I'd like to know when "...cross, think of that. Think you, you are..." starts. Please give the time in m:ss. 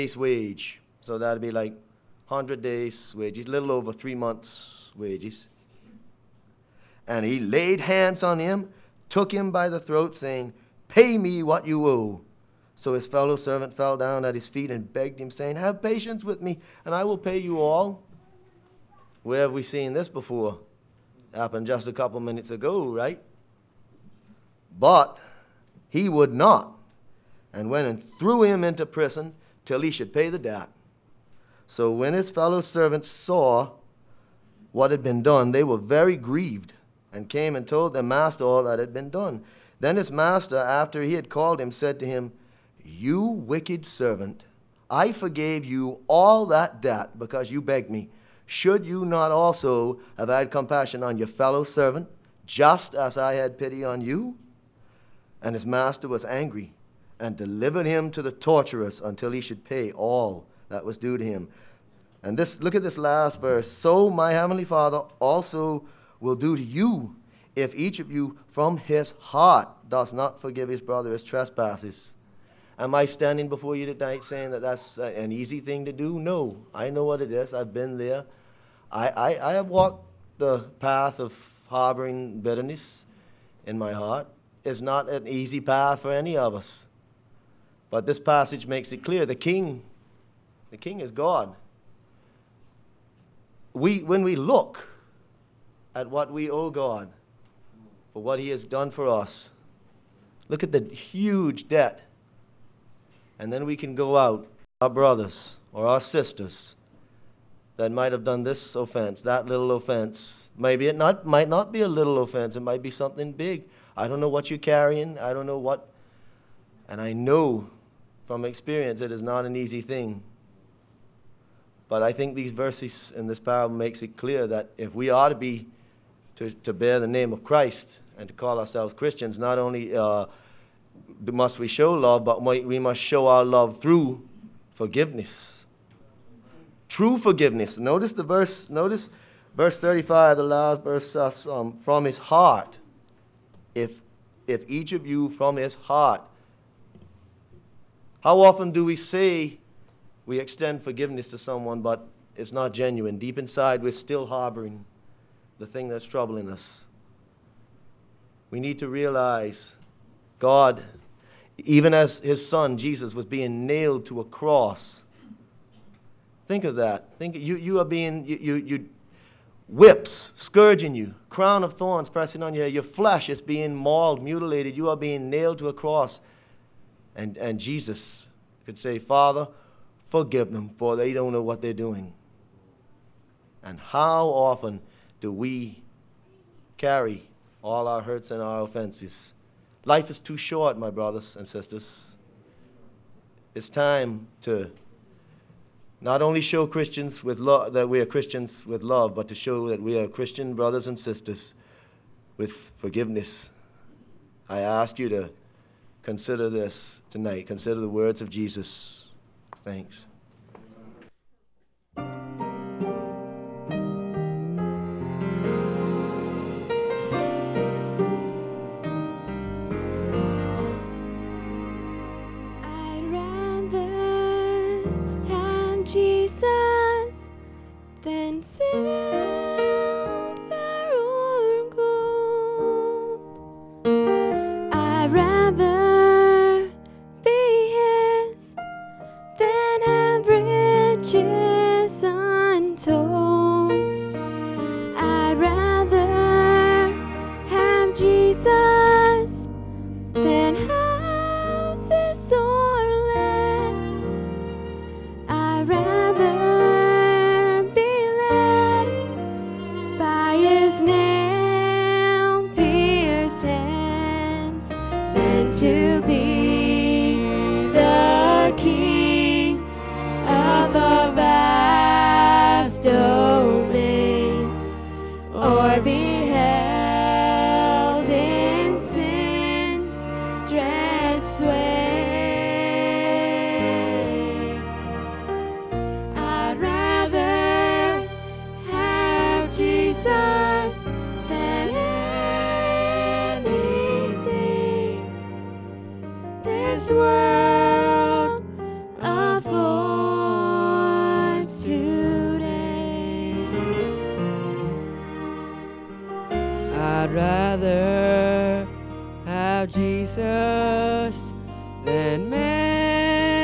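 2:44.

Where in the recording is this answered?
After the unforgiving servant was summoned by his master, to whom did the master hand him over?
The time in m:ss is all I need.
0:58.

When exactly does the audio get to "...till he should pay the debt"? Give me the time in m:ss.
0:29.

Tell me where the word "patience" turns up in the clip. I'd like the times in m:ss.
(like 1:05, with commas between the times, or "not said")
0:15.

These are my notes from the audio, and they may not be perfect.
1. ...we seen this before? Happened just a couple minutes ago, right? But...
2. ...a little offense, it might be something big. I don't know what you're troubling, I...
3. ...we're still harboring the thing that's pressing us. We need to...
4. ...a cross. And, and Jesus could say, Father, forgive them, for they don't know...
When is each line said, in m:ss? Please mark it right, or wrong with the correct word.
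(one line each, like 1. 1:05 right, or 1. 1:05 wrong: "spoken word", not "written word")
1. 0:19 right
2. 1:51 wrong: "carrying", not "troubling"
3. 2:33 wrong: "troubling", not "pressing"
4. 2:55 right.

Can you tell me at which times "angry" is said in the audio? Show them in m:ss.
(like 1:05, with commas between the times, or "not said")
0:56.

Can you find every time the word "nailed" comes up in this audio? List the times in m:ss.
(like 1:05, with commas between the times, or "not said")
2:43, 2:55.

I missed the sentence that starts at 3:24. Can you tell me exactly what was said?
I ask you to consider this tonight.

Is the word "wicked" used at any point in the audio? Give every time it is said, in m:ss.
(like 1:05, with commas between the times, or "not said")
0:43.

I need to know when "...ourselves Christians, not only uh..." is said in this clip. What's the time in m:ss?
2:08.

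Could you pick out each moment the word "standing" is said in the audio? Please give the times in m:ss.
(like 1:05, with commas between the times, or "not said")
1:13.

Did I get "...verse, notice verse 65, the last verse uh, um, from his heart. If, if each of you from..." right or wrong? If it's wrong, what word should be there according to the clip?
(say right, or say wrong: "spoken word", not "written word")
wrong: "35", not "65".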